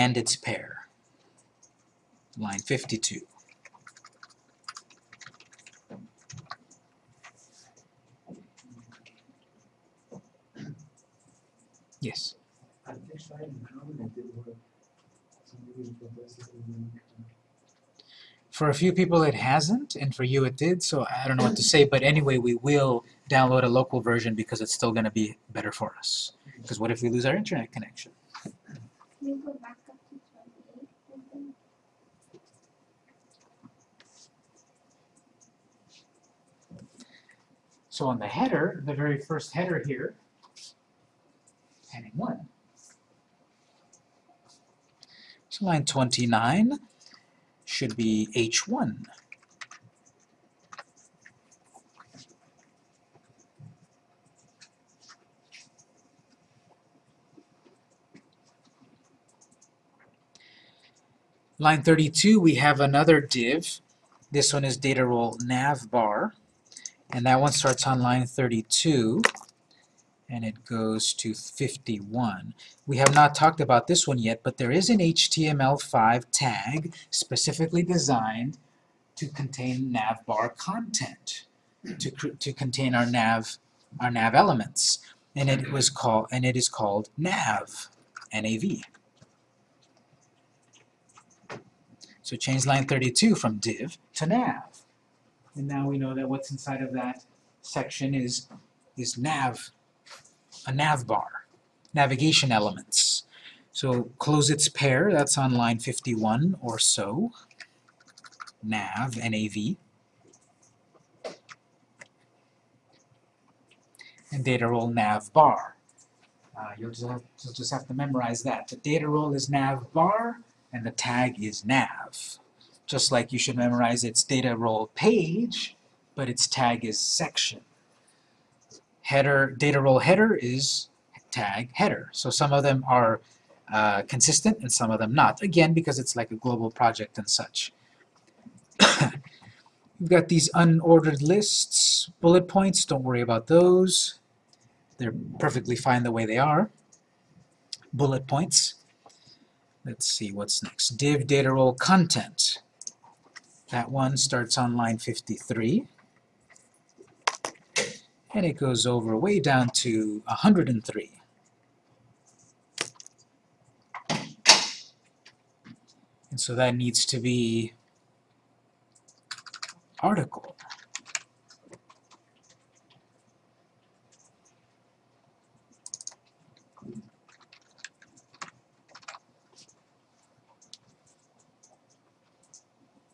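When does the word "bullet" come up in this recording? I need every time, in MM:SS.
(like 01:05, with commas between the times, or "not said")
02:22, 02:27.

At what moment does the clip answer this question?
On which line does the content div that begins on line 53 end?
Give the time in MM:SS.
02:40.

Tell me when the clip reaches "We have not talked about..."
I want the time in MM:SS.
01:12.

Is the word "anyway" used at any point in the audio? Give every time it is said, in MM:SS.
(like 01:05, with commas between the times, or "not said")
00:22.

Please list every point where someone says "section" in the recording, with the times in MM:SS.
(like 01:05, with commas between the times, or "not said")
01:37, 02:06.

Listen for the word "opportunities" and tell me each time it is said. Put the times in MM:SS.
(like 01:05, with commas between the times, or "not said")
not said.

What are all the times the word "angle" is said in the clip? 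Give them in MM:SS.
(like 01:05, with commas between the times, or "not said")
not said.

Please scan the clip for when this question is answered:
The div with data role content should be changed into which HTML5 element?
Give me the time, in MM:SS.
02:50.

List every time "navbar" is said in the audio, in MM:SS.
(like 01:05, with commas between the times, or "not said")
01:05, 01:19.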